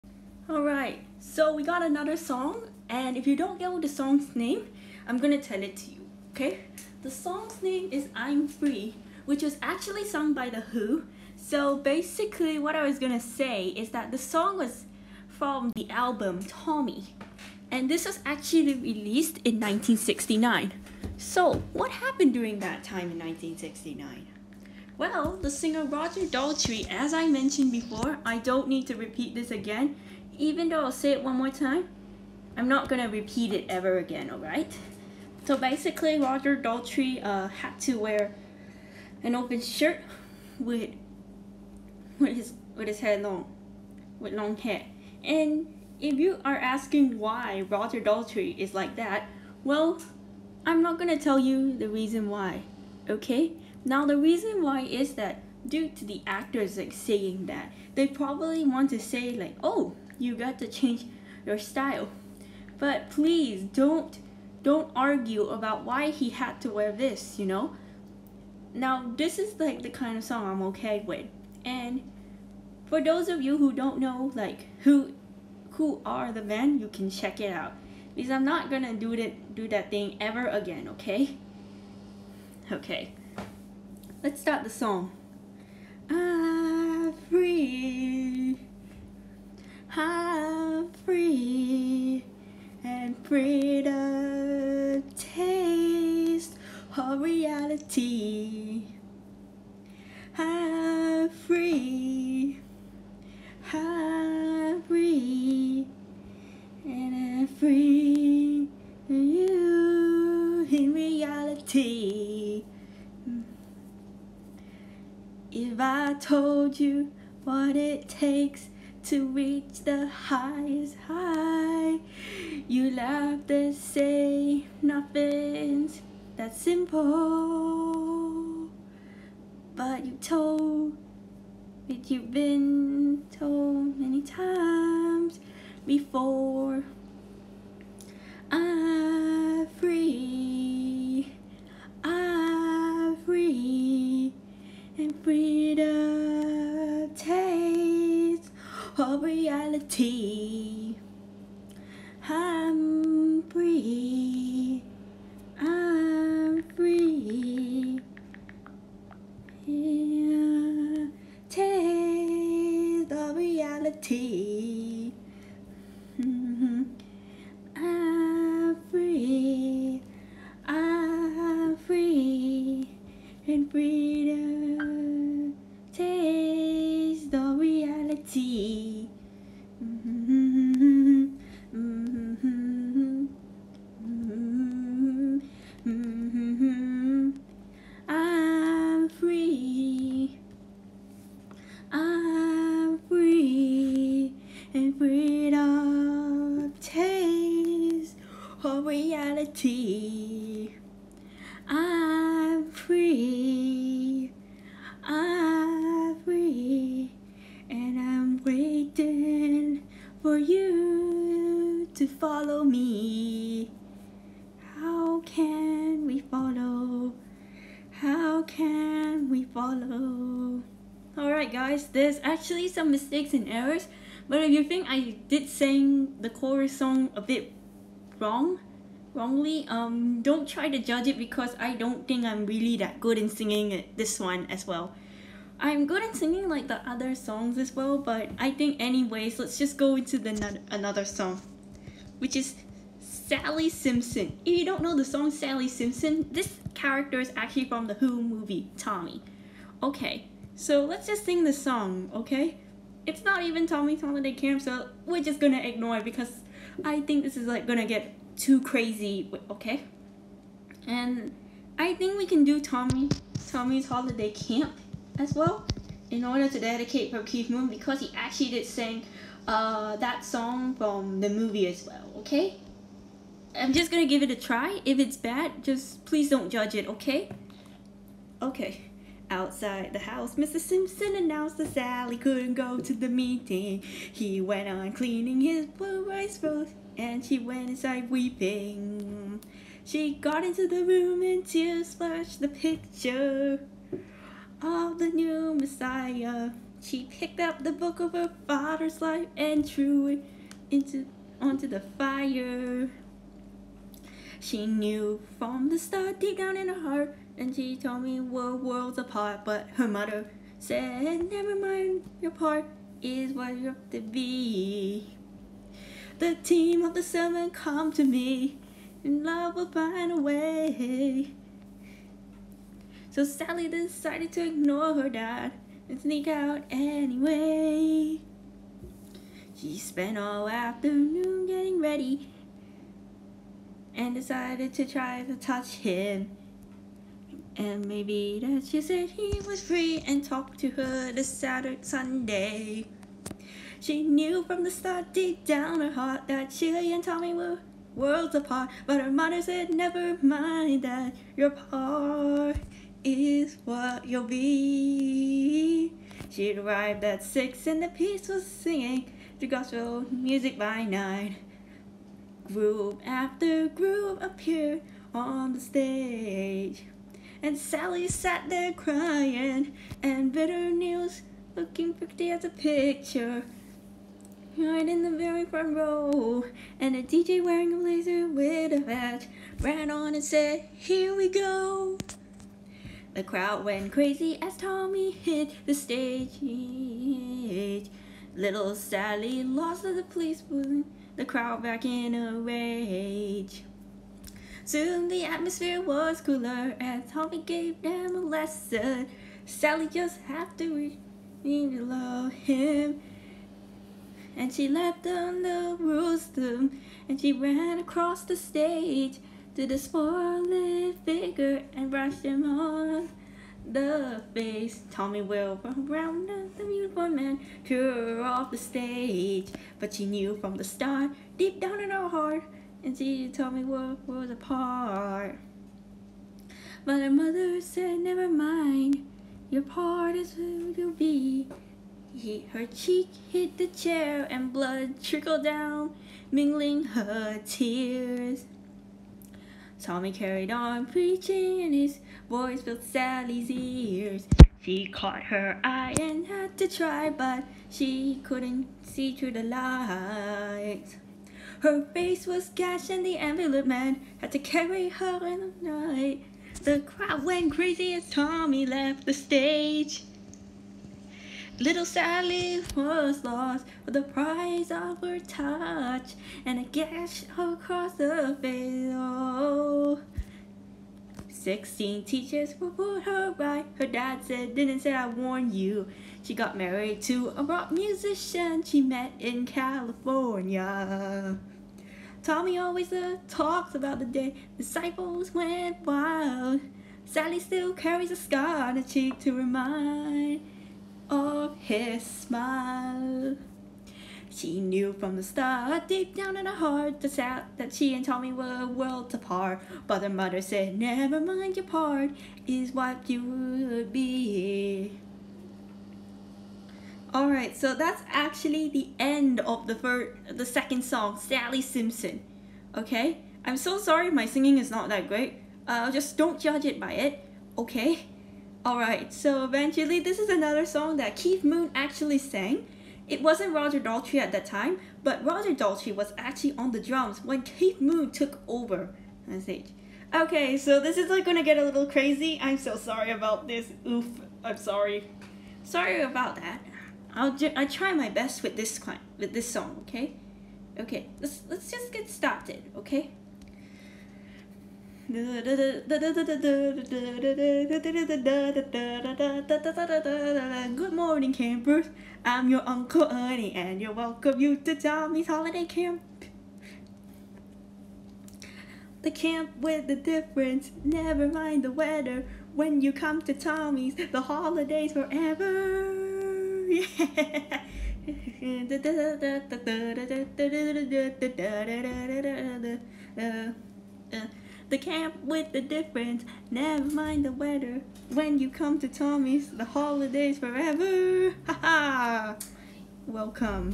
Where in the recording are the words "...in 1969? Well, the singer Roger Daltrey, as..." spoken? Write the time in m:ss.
0:23.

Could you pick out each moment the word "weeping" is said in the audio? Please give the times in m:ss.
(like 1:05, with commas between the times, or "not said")
4:48.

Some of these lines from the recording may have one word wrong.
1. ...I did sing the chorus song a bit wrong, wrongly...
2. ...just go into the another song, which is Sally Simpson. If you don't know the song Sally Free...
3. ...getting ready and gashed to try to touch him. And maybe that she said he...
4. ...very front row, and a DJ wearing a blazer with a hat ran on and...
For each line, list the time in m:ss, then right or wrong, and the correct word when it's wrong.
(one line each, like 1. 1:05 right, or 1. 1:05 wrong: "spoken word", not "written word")
1. 3:44 right
2. 3:59 wrong: "Simpson", not "Free"
3. 5:31 wrong: "decided", not "gashed"
4. 6:15 right.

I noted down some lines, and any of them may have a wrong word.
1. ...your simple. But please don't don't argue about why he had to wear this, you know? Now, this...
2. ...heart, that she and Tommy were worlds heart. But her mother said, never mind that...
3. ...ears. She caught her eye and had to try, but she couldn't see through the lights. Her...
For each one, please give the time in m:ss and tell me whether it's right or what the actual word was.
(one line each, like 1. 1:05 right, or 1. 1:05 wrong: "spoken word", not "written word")
1. 1:01 wrong: "style", not "simple"
2. 5:45 wrong: "apart", not "heart"
3. 7:23 right.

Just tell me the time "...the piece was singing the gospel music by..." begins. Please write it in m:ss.
5:57.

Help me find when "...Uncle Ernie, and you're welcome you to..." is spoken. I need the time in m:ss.
9:12.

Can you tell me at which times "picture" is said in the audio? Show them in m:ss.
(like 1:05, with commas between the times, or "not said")
4:52, 6:12.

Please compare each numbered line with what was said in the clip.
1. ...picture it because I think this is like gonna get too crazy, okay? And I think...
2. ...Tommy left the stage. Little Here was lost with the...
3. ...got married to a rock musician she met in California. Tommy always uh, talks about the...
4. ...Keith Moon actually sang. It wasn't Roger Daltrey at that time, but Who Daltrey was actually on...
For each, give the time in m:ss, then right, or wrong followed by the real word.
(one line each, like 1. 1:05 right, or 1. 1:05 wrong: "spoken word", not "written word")
1. 4:15 wrong: "ignore", not "picture"
2. 7:38 wrong: "Sally", not "Here"
3. 7:56 right
4. 8:41 wrong: "Roger", not "Who".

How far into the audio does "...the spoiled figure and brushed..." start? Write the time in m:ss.
6:49.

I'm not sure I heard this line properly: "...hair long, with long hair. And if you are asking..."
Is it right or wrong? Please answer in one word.
right.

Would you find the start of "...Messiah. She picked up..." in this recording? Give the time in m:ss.
4:55.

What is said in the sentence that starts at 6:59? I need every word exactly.
But she knew from the start, deep down in her heart, and she told me what was apart.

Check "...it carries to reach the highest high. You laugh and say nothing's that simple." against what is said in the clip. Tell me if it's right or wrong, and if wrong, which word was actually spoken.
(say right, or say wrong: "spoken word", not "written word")
wrong: "takes", not "carries".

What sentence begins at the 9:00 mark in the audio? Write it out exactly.
Okay, let's let's just get started, okay?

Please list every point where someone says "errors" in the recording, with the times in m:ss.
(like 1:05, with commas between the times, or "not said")
3:43.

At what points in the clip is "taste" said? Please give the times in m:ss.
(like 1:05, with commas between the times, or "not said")
1:35, 2:41.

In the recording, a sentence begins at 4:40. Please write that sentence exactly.
Simpson announced that Sally couldn't go to the meeting.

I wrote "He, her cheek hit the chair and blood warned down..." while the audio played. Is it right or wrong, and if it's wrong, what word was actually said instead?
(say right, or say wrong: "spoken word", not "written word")
wrong: "trickled", not "warned".